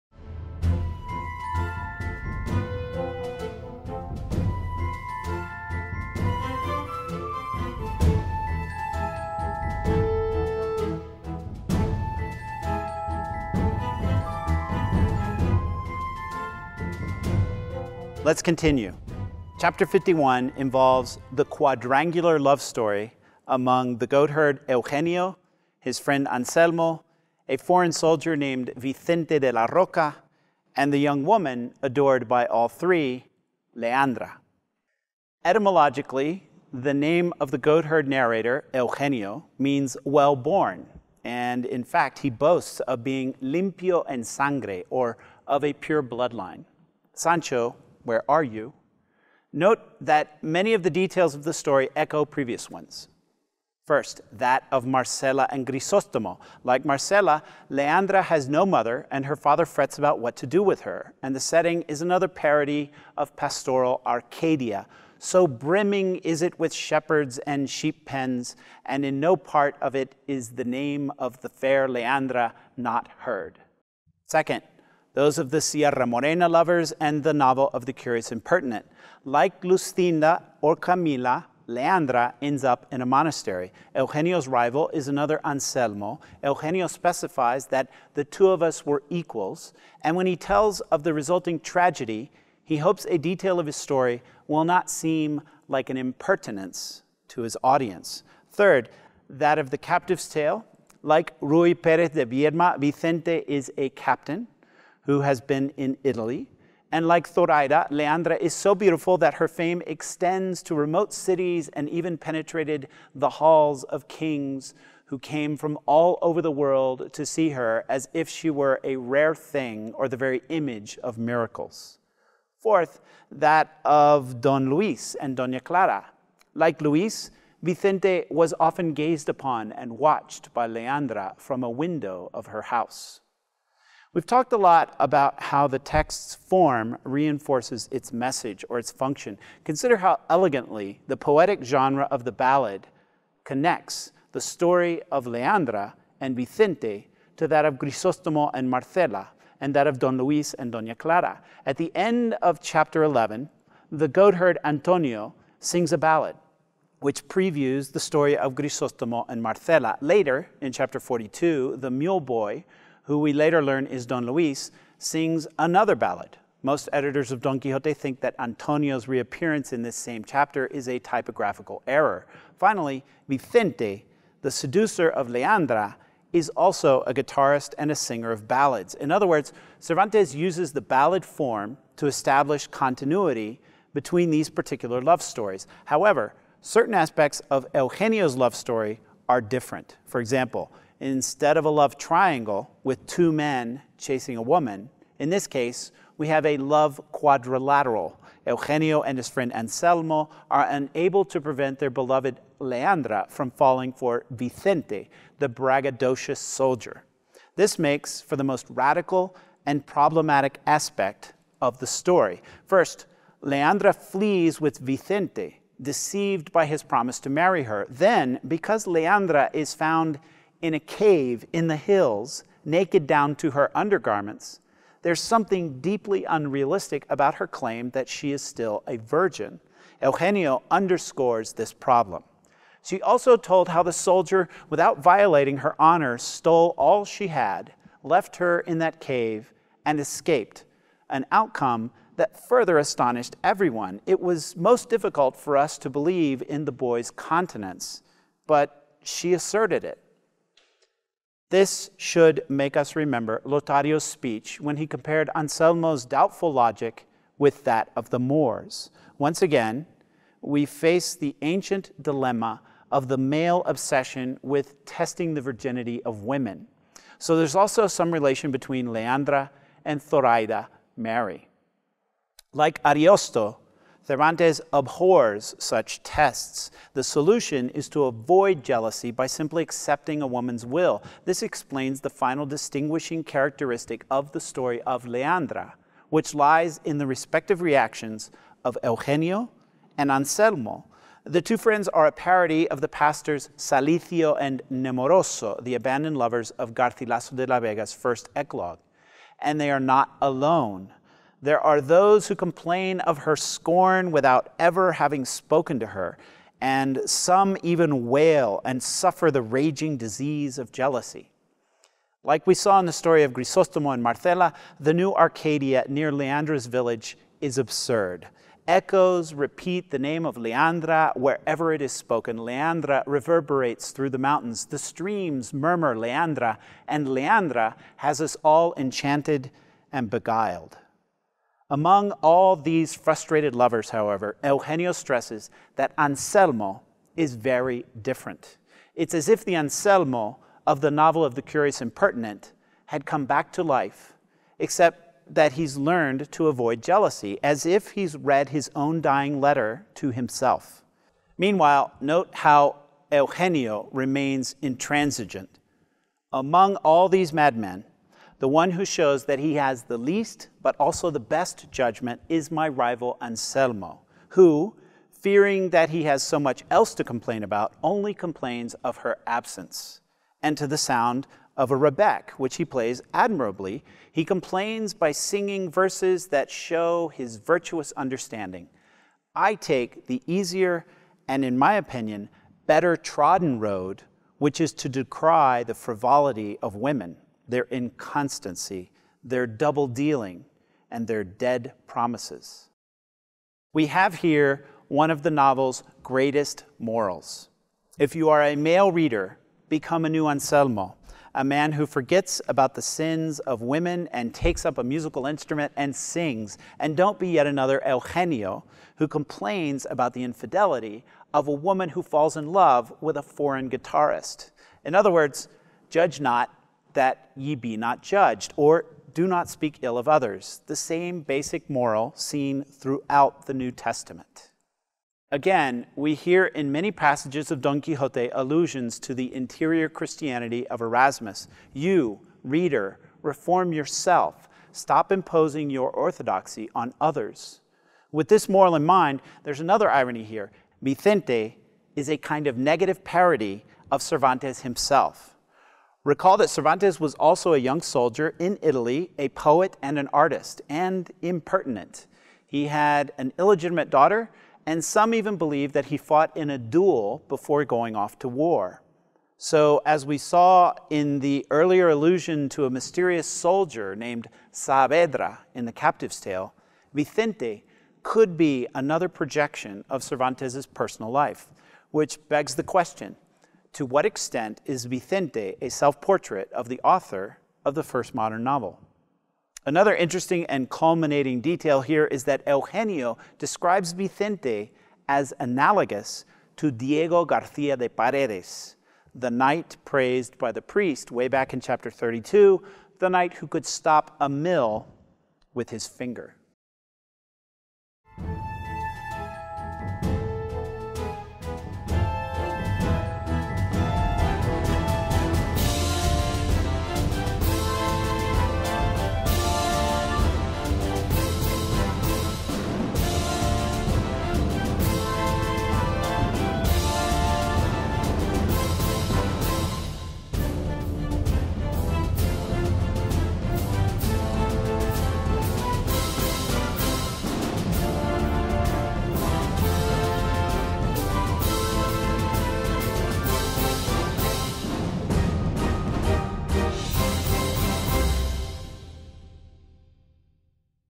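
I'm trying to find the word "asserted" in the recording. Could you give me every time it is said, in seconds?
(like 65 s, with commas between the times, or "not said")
249 s.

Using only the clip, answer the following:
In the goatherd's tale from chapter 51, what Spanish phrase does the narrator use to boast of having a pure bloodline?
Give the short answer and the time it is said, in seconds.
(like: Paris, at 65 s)
limpio en sangre, at 43 s.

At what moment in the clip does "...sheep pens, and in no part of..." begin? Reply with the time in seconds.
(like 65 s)
67 s.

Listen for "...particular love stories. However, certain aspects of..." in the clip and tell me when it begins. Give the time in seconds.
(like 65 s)
184 s.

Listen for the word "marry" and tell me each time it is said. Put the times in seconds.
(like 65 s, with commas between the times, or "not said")
217 s.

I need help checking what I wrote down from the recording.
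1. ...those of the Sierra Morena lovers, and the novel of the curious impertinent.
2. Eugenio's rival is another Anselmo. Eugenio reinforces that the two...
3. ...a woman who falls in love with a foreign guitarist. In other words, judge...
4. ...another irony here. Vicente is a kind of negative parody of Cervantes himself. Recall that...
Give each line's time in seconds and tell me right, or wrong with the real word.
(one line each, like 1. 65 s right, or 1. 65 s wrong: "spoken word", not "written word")
1. 75 s right
2. 83 s wrong: "specifies", not "reinforces"
3. 411 s right
4. 439 s right.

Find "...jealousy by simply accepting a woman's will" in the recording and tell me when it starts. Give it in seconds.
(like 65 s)
278 s.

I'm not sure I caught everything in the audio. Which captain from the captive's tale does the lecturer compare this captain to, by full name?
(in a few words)
Ruy Perez de Viedma.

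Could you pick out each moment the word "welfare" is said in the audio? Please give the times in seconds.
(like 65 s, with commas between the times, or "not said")
not said.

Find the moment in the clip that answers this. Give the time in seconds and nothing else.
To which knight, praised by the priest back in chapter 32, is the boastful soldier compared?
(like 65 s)
486 s.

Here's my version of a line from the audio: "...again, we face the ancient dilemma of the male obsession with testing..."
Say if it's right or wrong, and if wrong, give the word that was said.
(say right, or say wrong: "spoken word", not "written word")
right.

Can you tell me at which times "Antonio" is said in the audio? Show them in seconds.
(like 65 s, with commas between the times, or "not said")
154 s, 168 s.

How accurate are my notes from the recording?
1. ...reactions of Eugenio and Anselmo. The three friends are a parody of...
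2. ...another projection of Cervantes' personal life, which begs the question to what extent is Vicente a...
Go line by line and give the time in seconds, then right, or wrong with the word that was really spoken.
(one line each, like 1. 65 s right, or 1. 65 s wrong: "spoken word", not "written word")
1. 287 s wrong: "two", not "three"
2. 468 s right.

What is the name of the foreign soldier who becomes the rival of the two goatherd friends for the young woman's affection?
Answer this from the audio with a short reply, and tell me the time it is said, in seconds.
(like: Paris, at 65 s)
Vicente de la Roca, at 28 s.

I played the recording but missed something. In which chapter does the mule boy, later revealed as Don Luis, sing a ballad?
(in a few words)
42.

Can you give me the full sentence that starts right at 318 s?
Echoes repeat the name of Leandra wherever it is spoken.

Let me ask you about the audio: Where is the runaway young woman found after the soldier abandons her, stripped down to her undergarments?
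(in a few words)
a cave in the hills.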